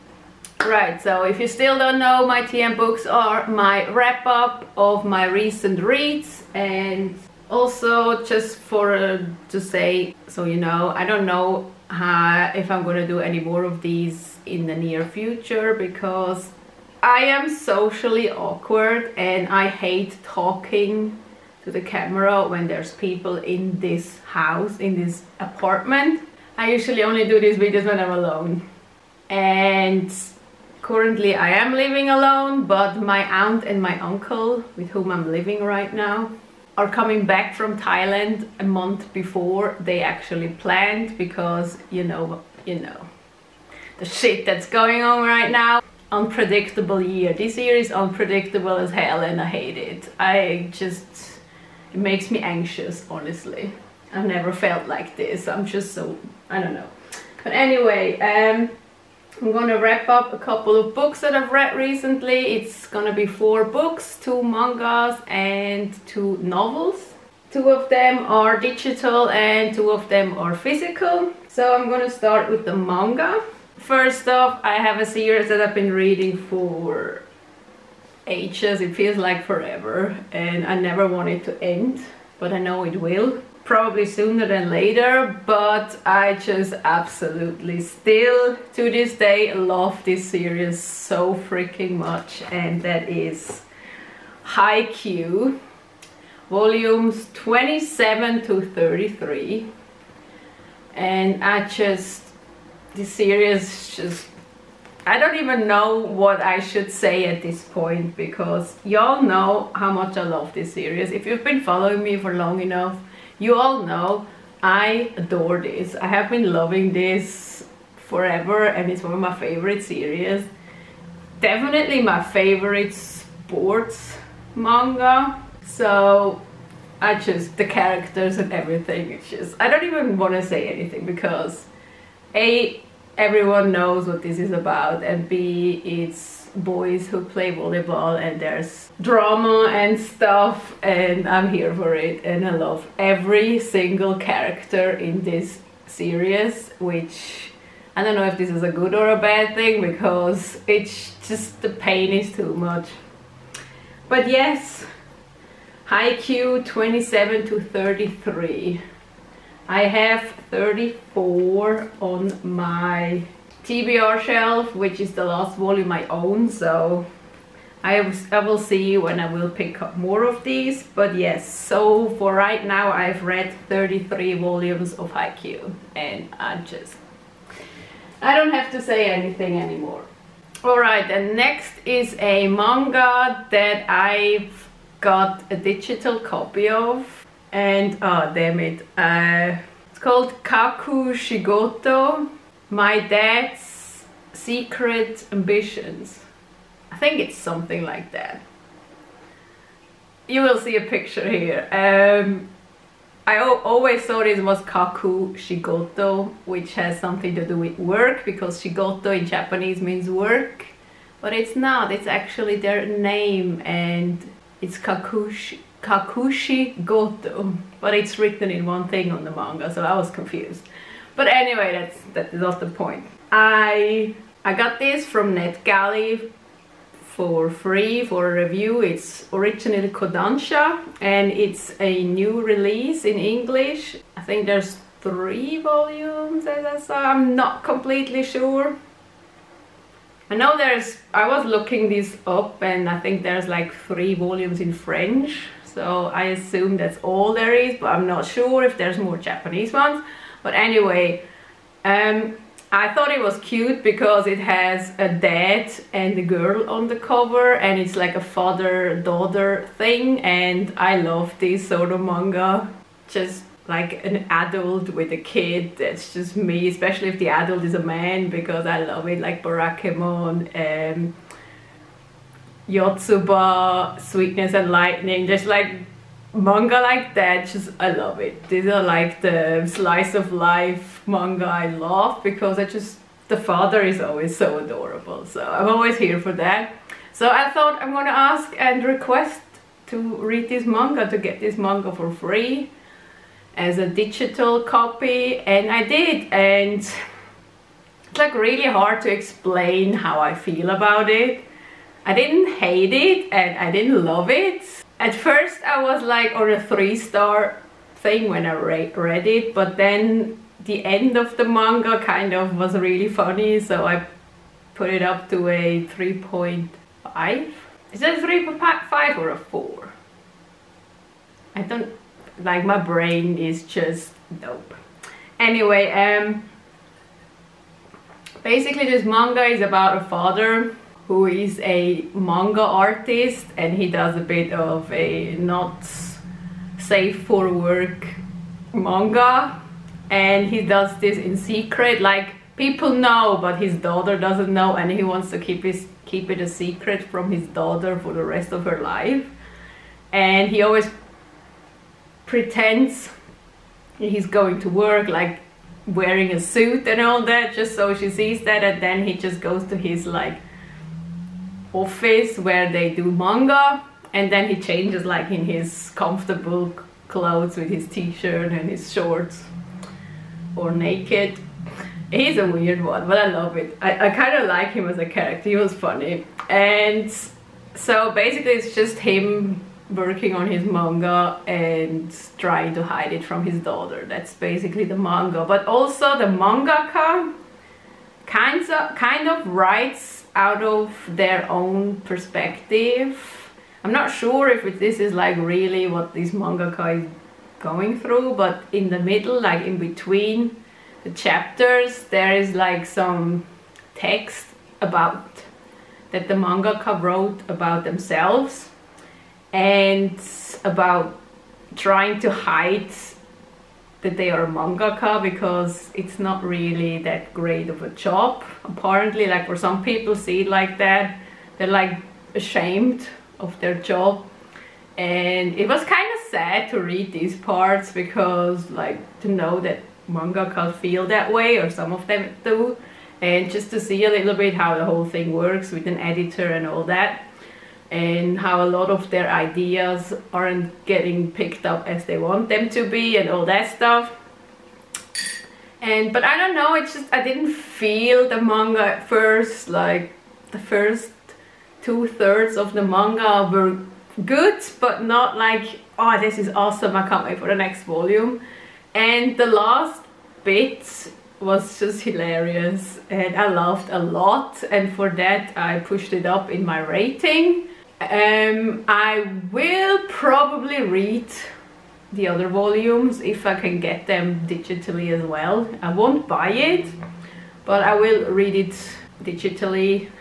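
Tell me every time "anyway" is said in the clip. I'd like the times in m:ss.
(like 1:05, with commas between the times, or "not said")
0:57, 3:41, 4:10, 5:25.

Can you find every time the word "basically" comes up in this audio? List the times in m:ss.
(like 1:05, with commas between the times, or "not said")
5:28, 6:18, 6:24.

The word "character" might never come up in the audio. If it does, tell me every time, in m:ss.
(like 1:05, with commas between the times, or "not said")
2:07, 2:24, 6:15.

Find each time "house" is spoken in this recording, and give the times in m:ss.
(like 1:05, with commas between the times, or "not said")
0:24.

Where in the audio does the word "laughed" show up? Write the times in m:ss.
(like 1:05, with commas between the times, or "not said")
7:43.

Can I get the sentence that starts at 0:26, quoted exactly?
I usually only do these videos when I'm alone.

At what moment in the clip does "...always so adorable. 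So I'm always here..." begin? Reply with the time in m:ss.
4:44.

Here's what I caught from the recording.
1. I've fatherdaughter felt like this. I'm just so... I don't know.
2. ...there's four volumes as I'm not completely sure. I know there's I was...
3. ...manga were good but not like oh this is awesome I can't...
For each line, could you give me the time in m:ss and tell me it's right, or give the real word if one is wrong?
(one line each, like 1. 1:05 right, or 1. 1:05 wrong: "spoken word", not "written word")
1. 0:54 wrong: "never", not "fatherdaughter"
2. 3:54 wrong: "three", not "four"
3. 7:32 right.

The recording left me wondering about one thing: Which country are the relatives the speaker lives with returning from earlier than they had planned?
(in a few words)
Thailand.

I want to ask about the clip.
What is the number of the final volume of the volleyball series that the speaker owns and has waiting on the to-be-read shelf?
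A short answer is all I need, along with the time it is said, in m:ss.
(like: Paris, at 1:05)
34, at 2:40.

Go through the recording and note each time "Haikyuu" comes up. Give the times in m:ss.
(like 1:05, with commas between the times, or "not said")
1:34, 2:35, 2:55.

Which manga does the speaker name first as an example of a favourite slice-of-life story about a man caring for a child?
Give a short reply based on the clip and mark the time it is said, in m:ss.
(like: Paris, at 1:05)
Barakamon, at 4:29.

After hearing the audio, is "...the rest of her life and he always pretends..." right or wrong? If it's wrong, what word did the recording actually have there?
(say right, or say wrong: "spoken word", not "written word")
right.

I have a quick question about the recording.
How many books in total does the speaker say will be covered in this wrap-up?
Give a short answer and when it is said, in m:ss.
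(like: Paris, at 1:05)
4, at 1:03.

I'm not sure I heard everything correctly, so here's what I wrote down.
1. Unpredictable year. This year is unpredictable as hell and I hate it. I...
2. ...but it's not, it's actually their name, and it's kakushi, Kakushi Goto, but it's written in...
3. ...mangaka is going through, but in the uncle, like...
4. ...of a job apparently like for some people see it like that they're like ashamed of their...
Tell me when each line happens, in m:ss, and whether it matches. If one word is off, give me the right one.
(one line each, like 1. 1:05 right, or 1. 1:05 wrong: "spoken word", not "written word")
1. 0:46 right
2. 3:31 right
3. 6:36 wrong: "middle", not "uncle"
4. 6:57 right.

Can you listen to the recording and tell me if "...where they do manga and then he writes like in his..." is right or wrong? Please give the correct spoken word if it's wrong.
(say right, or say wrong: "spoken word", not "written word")
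wrong: "changes", not "writes".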